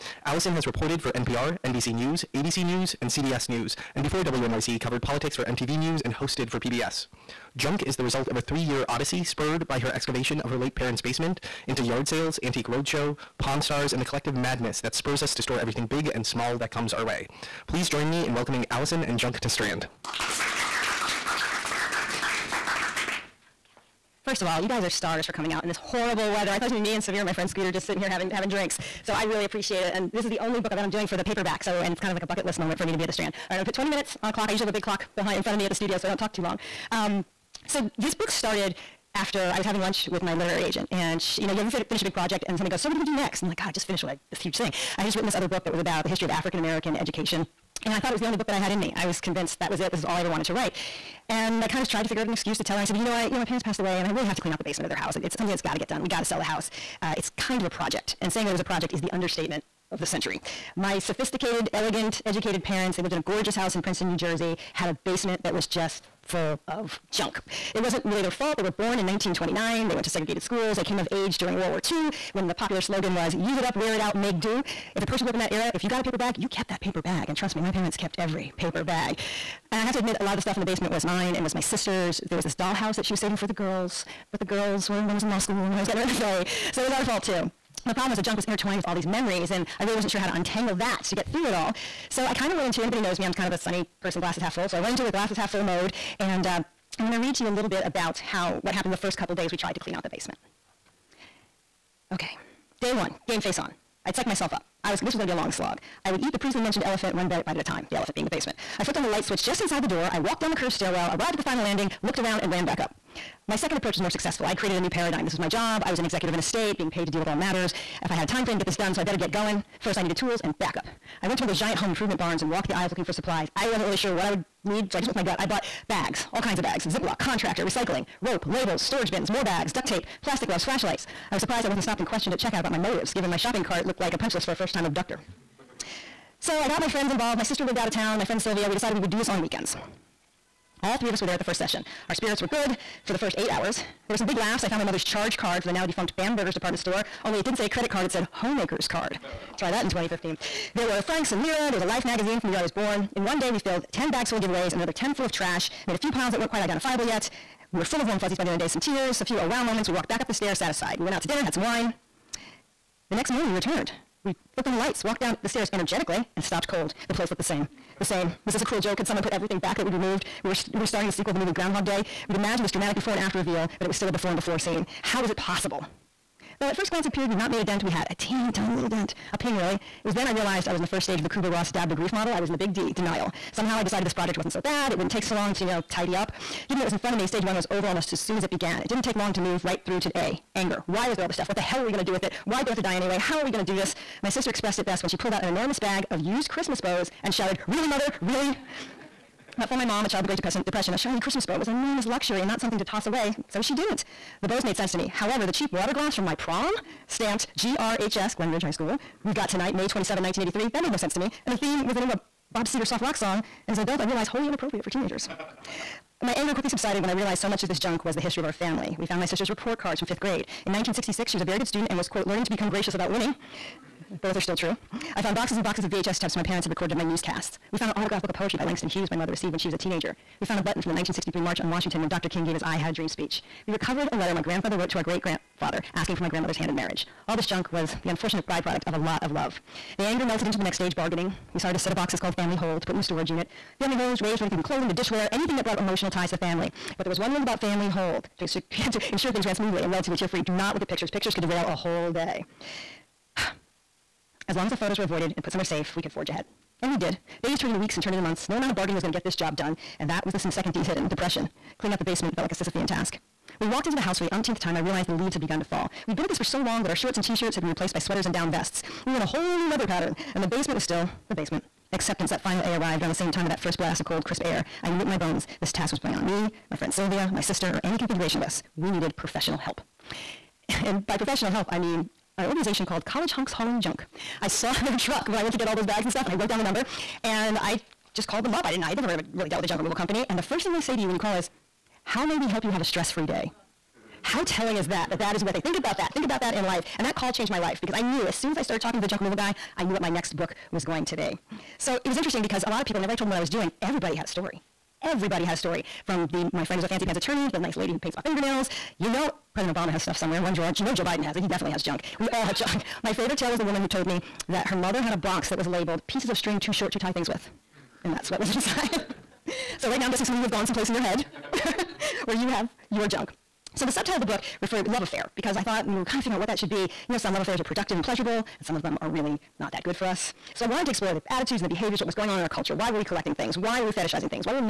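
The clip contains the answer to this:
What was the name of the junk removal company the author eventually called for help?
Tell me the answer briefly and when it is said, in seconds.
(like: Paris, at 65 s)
College Hunks Hauling Junk, at 283 s.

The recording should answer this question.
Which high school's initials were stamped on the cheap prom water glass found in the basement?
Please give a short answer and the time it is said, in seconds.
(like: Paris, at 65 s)
Glen Ridge High School, at 208 s.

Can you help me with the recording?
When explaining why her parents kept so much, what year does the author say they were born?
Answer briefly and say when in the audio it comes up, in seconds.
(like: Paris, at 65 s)
1929, at 69 s.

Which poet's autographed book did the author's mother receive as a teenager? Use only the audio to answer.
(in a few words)
Langston Hughes.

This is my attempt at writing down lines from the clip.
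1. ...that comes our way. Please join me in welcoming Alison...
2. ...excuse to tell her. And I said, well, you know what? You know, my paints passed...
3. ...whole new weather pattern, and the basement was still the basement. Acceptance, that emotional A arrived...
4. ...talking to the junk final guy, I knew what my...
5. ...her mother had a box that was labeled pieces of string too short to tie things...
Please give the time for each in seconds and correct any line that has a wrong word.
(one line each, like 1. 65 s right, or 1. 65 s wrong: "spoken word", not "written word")
1. 16 s right
2. 52 s wrong: "parents", not "paints"
3. 269 s wrong: "final", not "emotional"
4. 298 s wrong: "removal", not "final"
5. 314 s right.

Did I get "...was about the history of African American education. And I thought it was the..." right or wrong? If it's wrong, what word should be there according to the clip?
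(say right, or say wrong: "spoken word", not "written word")
right.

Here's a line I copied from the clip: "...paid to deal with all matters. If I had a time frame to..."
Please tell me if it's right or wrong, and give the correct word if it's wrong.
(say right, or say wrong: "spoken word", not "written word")
right.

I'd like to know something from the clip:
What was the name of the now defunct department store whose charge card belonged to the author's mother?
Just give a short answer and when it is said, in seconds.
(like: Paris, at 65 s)
Bamberger's, at 146 s.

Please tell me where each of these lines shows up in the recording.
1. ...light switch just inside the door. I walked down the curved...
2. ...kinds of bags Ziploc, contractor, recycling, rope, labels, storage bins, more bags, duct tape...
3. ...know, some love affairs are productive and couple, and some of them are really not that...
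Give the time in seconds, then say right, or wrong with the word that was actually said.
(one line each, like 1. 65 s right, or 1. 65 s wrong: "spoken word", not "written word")
1. 109 s right
2. 126 s right
3. 327 s wrong: "pleasurable", not "couple".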